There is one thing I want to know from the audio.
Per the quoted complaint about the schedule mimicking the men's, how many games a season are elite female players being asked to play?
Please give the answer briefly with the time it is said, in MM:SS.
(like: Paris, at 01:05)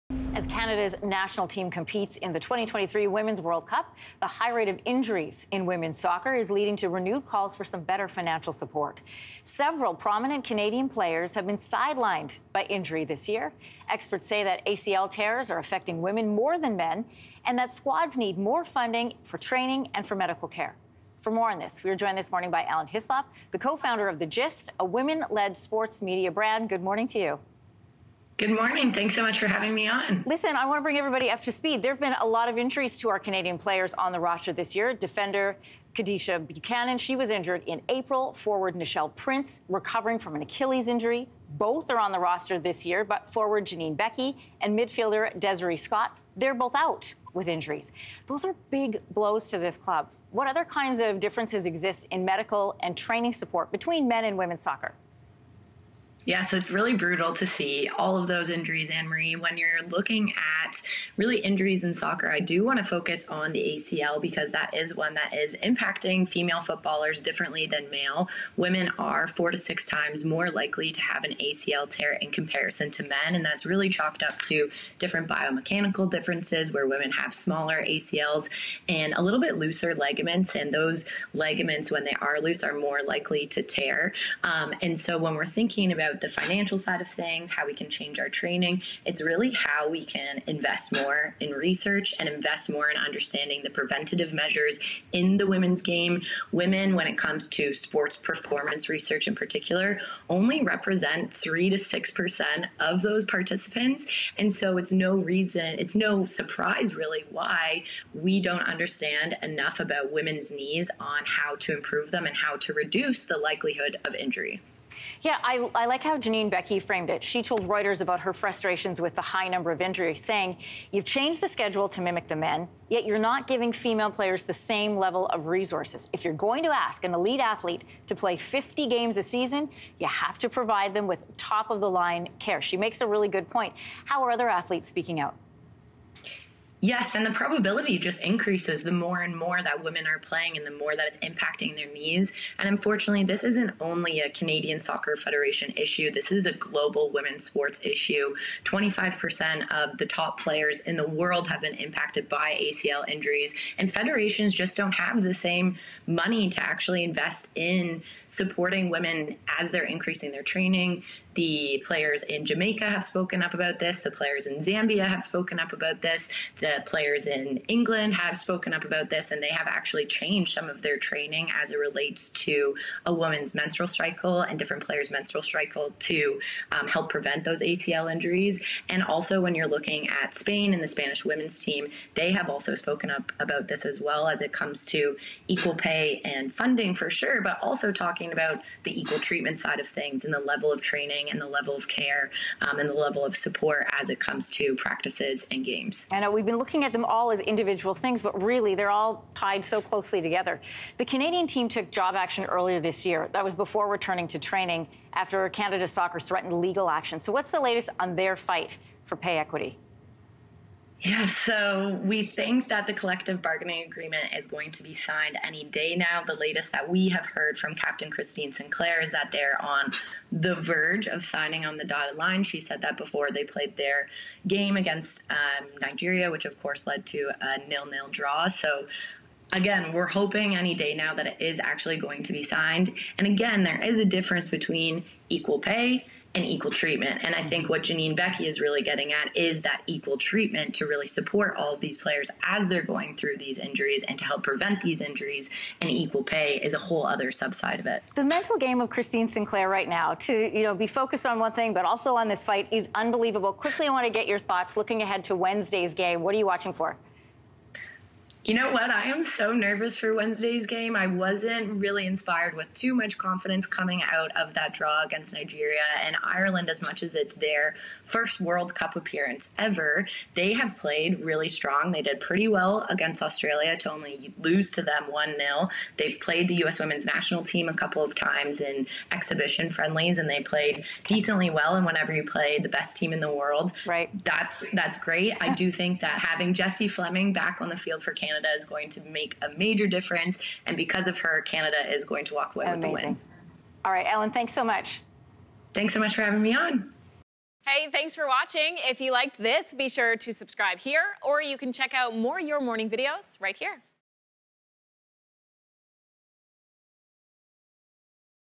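50, at 02:08.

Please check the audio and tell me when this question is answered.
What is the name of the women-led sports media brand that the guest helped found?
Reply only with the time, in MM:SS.
00:24.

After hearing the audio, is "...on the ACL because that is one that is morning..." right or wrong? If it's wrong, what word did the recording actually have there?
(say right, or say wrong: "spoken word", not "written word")
wrong: "impacting", not "morning".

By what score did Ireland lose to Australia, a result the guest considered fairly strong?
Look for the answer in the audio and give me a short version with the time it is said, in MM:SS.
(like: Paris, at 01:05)
1-0, at 04:35.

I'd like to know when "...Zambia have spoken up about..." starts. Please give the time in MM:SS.
02:44.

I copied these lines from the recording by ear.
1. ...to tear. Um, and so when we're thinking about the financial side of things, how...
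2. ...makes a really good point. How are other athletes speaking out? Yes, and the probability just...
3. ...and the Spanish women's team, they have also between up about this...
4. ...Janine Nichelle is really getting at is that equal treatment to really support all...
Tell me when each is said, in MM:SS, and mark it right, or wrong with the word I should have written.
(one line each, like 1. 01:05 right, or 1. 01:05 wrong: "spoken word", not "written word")
1. 01:23 right
2. 02:12 right
3. 03:00 wrong: "spoken", not "between"
4. 03:57 wrong: "Beckie", not "Nichelle".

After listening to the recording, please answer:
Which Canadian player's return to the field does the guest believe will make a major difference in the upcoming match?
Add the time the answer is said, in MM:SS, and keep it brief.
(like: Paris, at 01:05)
Jessie Fleming, at 04:46.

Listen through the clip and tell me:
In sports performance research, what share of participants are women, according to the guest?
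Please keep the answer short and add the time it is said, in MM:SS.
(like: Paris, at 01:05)
3 to 6%, at 01:41.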